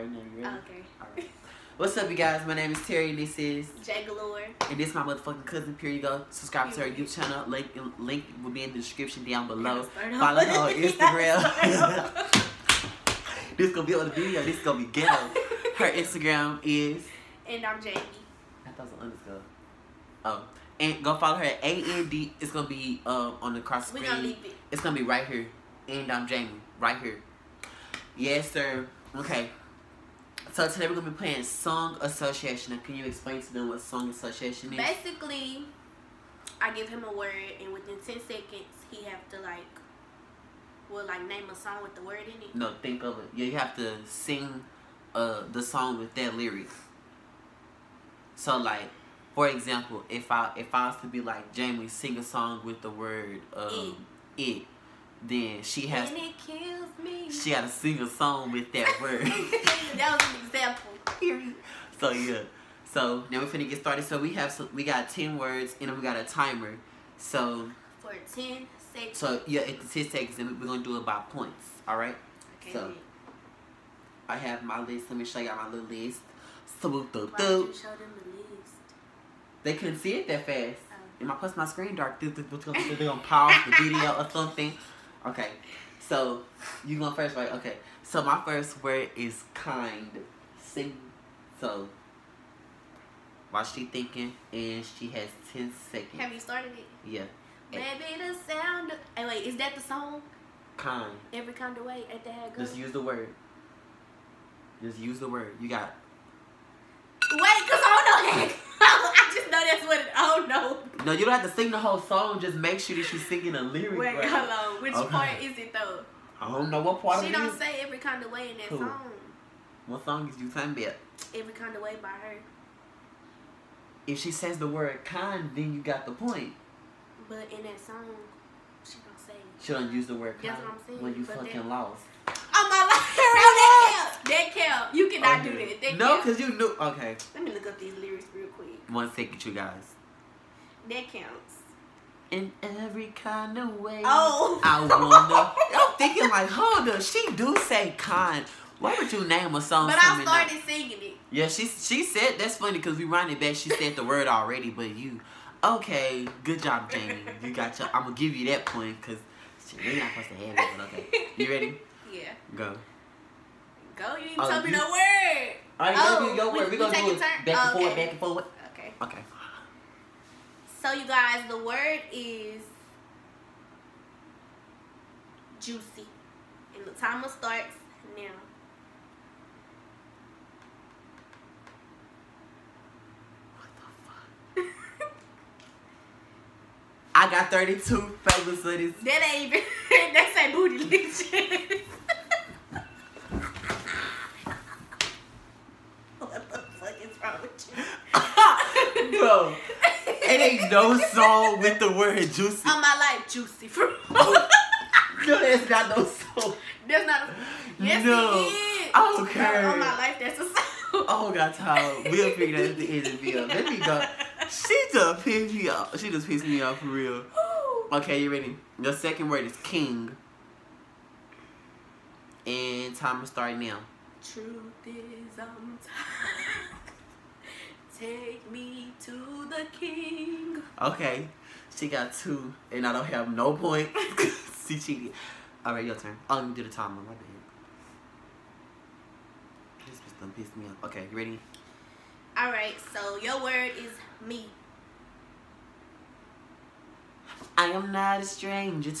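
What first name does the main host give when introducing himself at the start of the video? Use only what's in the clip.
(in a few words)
Terry.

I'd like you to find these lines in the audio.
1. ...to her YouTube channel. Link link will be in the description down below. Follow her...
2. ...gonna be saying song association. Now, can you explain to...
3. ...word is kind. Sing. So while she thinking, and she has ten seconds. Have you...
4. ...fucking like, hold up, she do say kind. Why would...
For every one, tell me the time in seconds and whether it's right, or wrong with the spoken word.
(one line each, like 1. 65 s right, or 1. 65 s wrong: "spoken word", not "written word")
1. 6 s right
2. 30 s wrong: "playing", not "saying"
3. 88 s right
4. 145 s wrong: "thinking", not "fucking".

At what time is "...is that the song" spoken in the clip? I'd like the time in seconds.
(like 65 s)
99 s.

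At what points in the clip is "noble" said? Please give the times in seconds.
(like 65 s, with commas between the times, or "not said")
not said.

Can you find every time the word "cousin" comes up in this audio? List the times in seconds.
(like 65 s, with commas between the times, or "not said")
5 s.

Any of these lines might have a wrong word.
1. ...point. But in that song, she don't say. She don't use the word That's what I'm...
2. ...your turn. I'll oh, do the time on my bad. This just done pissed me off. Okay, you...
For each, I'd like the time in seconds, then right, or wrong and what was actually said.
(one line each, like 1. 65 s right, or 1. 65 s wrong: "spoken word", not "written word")
1. 126 s right
2. 235 s right.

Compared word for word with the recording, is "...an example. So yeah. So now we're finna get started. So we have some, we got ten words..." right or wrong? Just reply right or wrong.
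right.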